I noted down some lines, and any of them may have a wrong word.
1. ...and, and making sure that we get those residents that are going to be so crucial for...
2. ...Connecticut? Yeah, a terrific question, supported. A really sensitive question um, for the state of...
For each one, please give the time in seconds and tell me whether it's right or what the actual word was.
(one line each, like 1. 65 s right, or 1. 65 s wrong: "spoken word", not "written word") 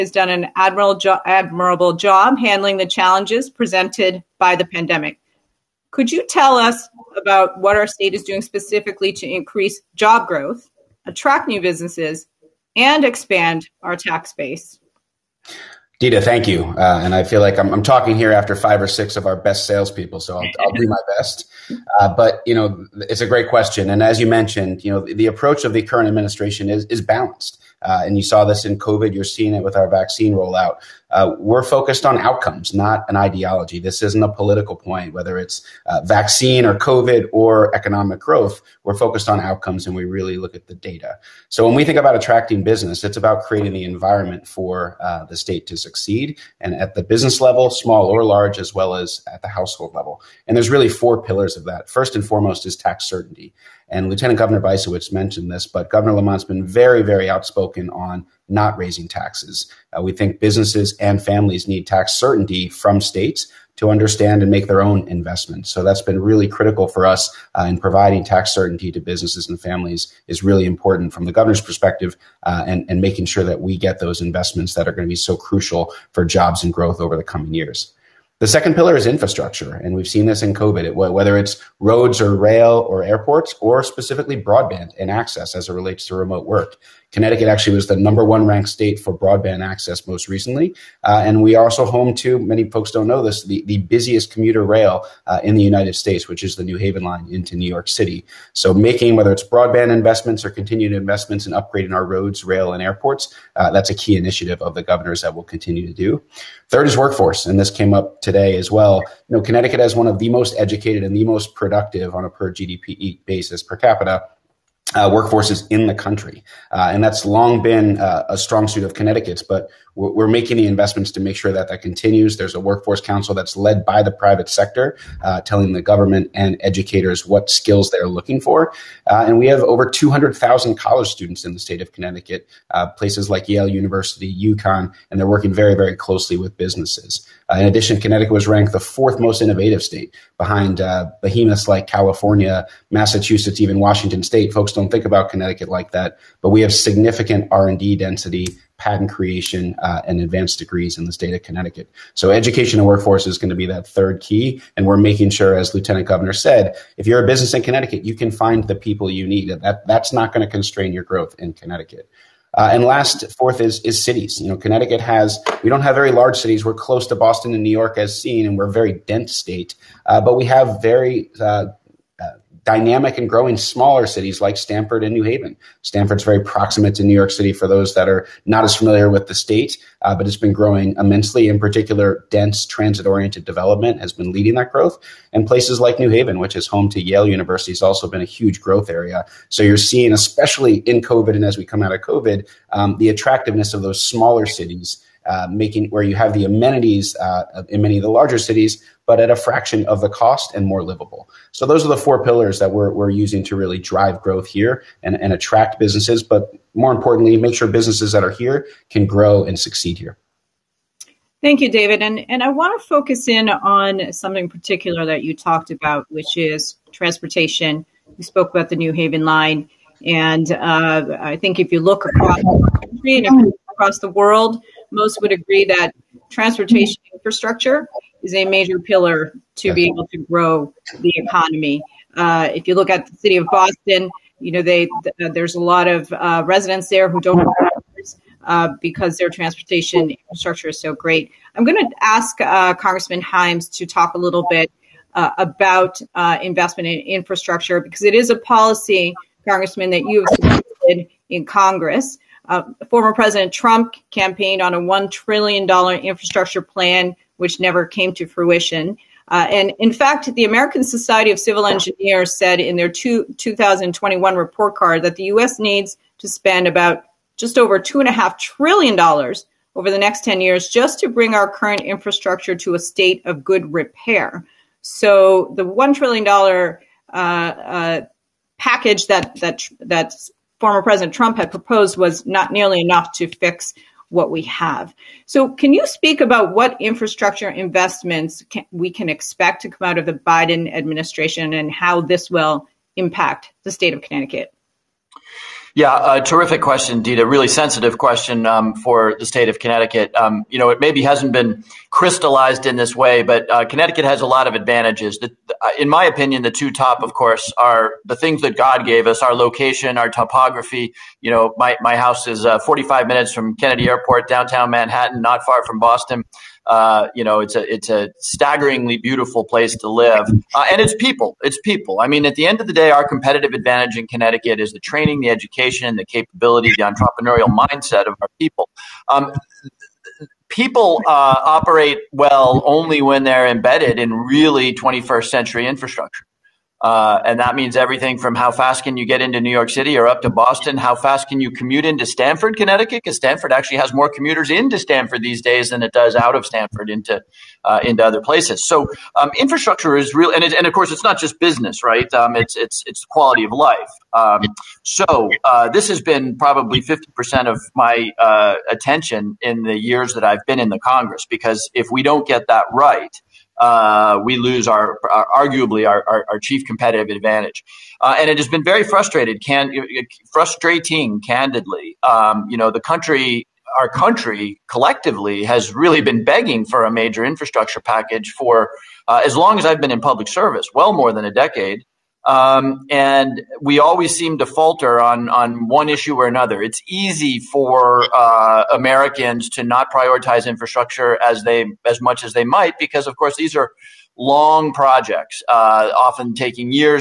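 1. 72 s wrong: "investments", not "residents"
2. 294 s wrong: "indeed", not "supported".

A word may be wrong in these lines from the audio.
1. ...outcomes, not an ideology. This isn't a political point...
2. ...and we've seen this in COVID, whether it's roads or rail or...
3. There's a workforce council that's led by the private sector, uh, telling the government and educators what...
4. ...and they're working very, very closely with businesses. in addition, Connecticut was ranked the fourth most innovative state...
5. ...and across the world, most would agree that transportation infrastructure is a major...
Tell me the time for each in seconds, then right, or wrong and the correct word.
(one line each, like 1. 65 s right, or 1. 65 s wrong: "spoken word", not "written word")
1. 32 s right
2. 79 s right
3. 122 s right
4. 135 s right
5. 223 s right.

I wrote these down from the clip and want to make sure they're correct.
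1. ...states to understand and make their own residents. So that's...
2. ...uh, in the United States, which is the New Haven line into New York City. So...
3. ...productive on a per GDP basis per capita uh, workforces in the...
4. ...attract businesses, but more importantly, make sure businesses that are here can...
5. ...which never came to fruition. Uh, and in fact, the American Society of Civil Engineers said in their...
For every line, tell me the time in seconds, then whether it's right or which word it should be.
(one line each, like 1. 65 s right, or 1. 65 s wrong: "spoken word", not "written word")
1. 62 s wrong: "investments", not "residents"
2. 95 s right
3. 111 s right
4. 205 s right
5. 257 s right.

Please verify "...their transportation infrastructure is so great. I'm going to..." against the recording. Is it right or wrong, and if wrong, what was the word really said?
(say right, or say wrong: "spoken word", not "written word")
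right.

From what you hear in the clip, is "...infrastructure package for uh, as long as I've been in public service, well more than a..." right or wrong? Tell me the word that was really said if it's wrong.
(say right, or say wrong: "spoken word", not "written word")
right.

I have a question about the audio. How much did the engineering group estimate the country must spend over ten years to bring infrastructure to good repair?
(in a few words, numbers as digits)
just over $2.5 trillion.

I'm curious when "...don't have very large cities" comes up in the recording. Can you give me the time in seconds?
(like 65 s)
165 s.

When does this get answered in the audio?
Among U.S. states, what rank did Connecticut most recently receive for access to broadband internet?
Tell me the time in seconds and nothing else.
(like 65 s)
87 s.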